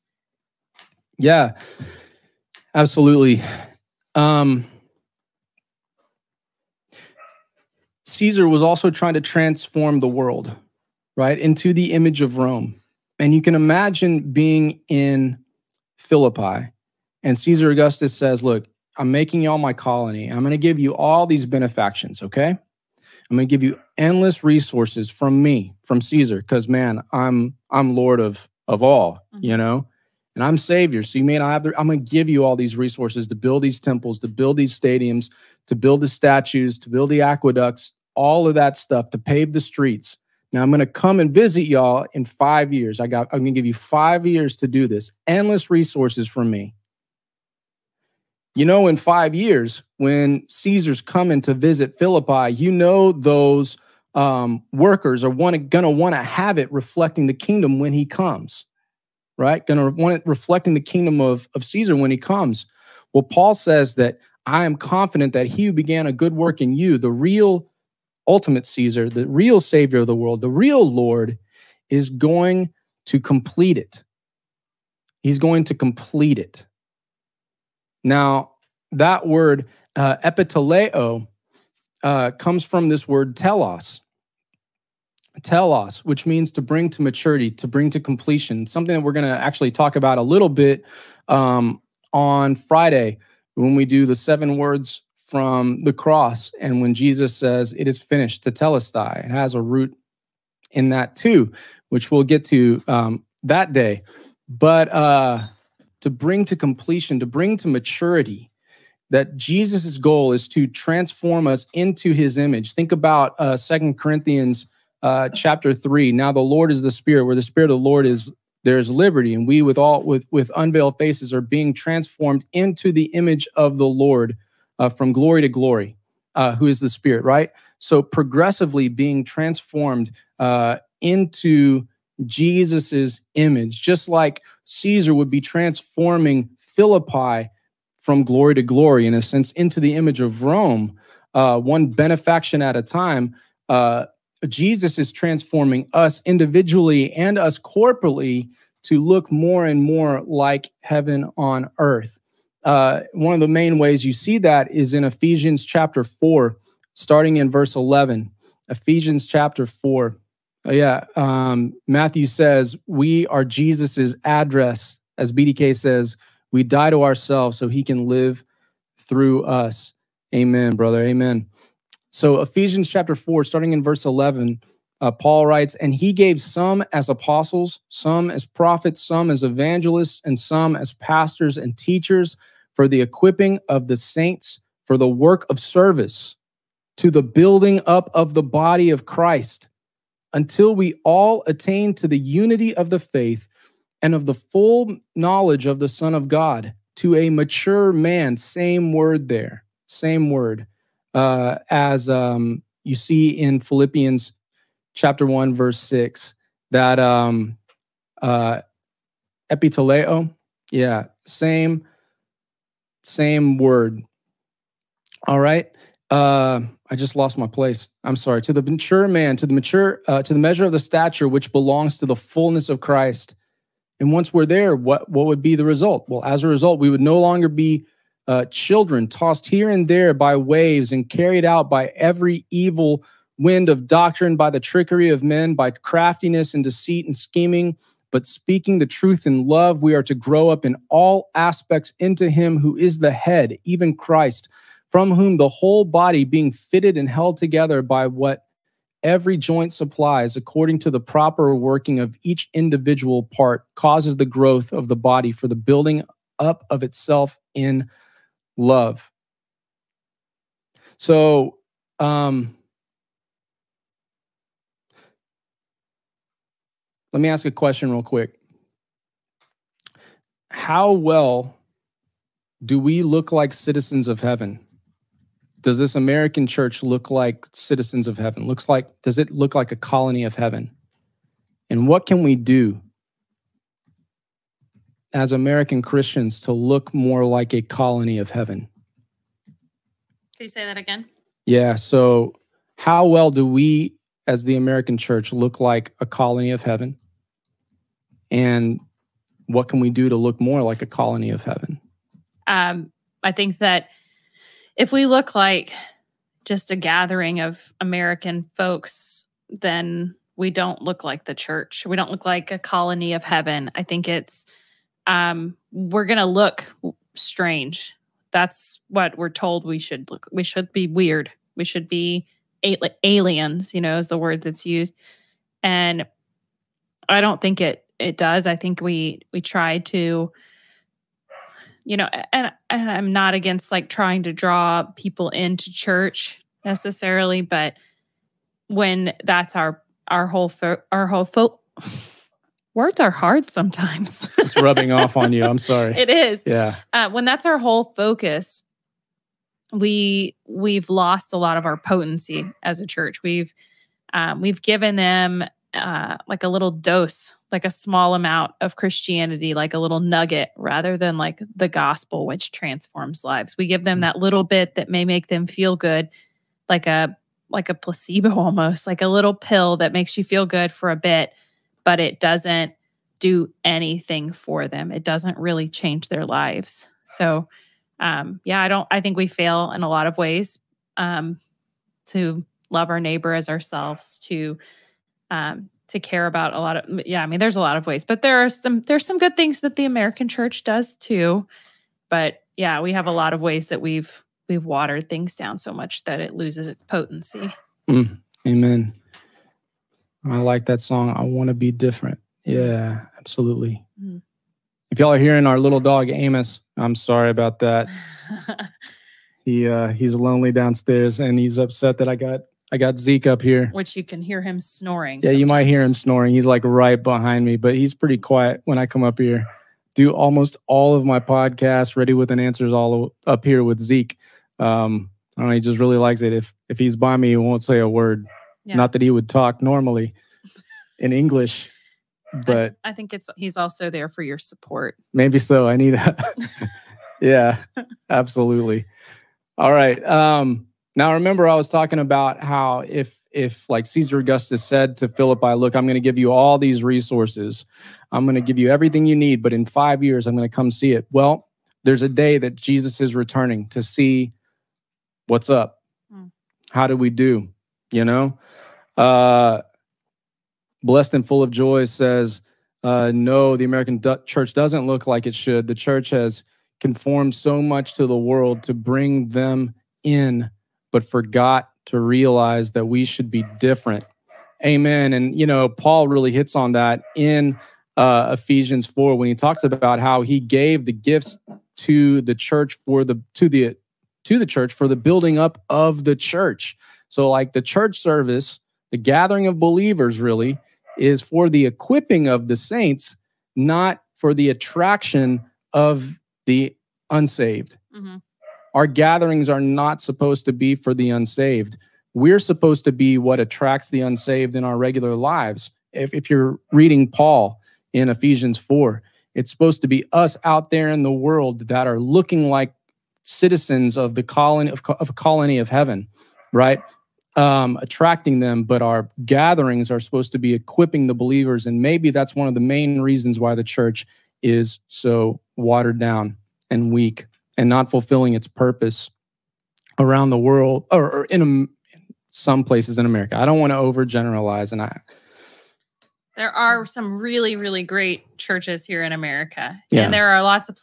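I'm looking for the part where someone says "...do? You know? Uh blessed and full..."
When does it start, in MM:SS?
07:37.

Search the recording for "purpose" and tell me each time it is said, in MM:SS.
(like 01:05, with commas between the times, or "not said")
08:48.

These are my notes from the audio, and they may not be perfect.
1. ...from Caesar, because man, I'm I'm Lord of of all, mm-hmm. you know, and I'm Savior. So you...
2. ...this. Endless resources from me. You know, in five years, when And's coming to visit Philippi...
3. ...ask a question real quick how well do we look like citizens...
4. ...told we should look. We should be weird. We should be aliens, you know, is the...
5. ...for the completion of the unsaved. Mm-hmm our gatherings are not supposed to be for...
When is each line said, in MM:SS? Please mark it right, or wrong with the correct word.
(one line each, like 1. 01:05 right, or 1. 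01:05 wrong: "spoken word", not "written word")
1. 00:25 right
2. 00:44 wrong: "Caesar", not "And"
3. 04:27 right
4. 05:19 right
5. 08:14 wrong: "attraction", not "completion".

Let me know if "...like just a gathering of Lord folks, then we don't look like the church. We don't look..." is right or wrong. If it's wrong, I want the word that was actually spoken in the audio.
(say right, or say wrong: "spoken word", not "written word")
wrong: "American", not "Lord".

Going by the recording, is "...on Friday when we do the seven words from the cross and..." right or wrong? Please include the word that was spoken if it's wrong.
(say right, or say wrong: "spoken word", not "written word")
right.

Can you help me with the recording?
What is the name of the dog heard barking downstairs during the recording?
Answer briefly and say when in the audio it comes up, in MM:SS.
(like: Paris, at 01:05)
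Amos, at 06:46.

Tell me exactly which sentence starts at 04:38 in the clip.
Looks like does it look like a colony of heaven?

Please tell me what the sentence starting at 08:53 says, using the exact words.
I don't want to overgeneralize, and I.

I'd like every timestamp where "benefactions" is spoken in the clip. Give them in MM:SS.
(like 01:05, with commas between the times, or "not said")
00:21, 02:21.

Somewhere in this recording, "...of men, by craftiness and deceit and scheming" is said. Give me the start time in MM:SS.
03:55.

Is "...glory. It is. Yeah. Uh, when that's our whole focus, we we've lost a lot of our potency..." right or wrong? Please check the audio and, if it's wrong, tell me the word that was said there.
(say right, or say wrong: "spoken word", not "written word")
wrong: "sorry", not "glory".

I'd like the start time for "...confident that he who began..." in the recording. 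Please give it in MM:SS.
01:04.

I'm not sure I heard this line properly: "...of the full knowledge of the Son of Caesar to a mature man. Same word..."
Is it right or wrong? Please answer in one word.
wrong.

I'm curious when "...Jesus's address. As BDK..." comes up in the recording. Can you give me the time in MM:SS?
02:43.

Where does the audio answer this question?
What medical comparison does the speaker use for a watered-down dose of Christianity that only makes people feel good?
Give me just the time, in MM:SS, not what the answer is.
06:07.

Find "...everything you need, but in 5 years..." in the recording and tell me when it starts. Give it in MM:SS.
07:28.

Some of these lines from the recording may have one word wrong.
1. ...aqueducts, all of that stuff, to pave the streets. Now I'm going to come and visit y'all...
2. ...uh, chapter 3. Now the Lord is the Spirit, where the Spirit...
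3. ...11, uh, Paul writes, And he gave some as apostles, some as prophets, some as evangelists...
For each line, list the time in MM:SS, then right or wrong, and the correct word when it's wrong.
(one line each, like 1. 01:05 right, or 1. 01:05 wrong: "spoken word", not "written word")
1. 00:37 right
2. 01:55 right
3. 02:54 right.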